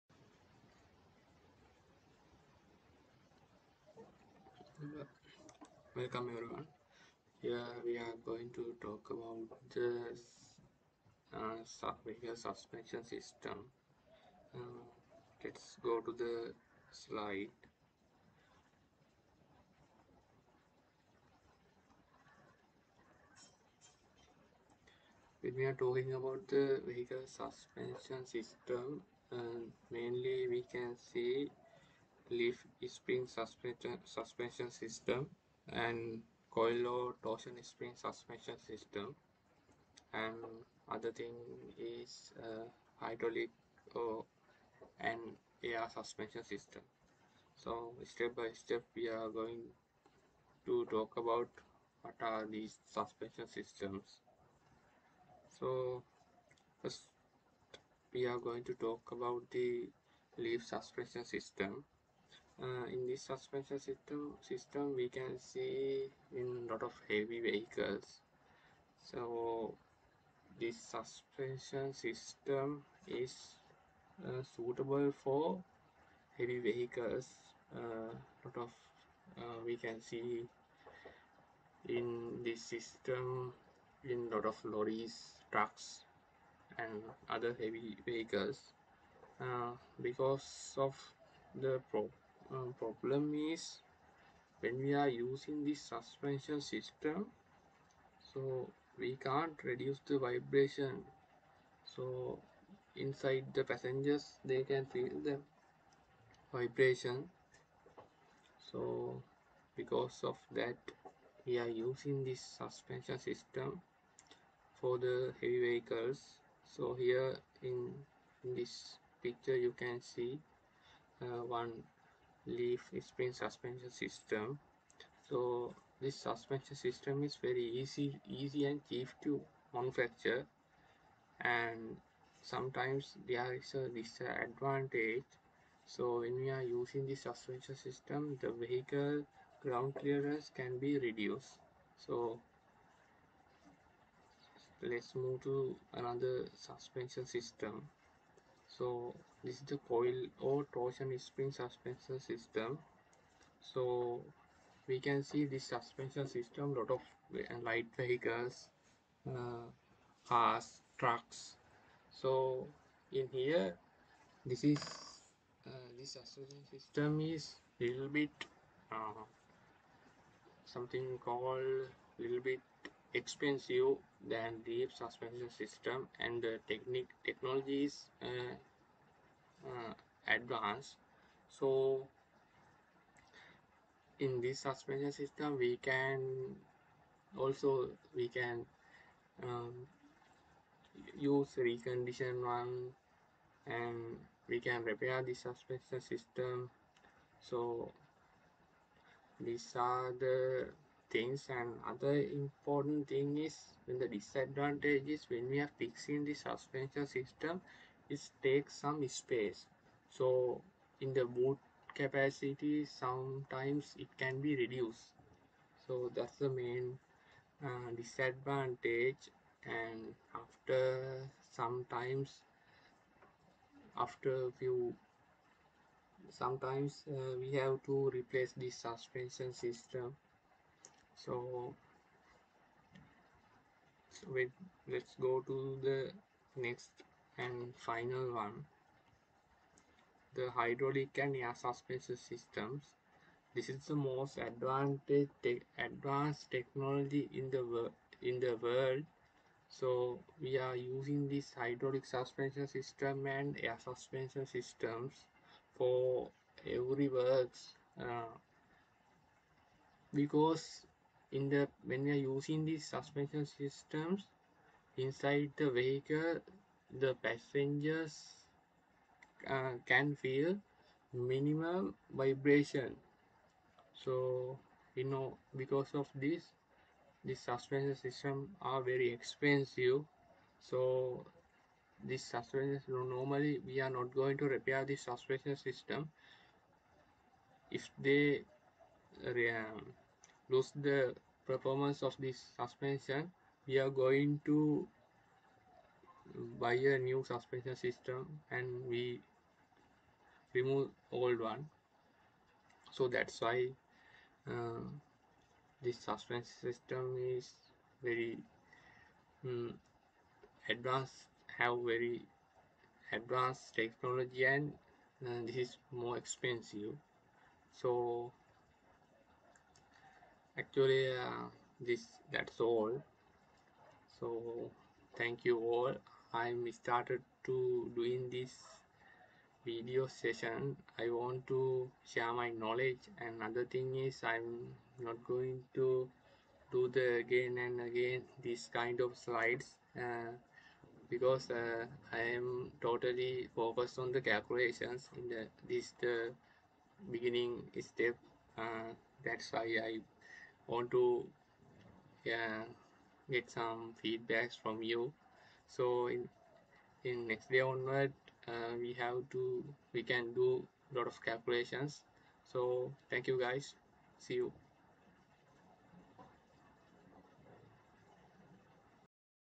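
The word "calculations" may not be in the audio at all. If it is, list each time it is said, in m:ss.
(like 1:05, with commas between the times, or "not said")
5:44, 6:01.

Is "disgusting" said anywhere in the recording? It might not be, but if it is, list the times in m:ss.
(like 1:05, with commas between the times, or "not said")
not said.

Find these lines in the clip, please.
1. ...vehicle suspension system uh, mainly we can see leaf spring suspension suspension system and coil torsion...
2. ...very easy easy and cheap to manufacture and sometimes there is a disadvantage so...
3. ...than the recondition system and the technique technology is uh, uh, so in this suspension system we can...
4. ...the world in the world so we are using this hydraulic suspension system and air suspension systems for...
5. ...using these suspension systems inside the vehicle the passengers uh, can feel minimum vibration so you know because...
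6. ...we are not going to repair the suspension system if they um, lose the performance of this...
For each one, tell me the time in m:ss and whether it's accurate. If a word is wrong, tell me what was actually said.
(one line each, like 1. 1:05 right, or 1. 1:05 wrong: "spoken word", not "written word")
1. 0:26 right
2. 2:07 right
3. 2:54 wrong: "suspension", not "recondition"
4. 4:07 right
5. 4:22 right
6. 4:43 right.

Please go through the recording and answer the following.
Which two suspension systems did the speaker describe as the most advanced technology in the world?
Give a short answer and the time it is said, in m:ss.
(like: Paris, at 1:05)
hydraulic and air, at 4:00.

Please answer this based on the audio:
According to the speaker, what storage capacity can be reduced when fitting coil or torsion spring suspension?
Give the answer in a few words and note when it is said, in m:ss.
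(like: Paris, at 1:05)
boot capacity, at 3:31.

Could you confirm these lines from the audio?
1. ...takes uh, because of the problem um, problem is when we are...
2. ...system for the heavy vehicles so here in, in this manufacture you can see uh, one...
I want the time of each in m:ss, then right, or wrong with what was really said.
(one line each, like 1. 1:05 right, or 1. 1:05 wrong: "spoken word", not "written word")
1. 1:28 wrong: "vehicles", not "takes"
2. 1:53 wrong: "picture", not "manufacture".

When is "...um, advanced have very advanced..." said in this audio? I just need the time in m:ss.
5:09.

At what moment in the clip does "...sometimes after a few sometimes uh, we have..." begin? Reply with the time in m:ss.
3:41.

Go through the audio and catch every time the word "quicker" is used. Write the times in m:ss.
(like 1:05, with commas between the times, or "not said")
not said.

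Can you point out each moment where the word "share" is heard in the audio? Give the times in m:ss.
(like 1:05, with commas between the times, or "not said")
5:32.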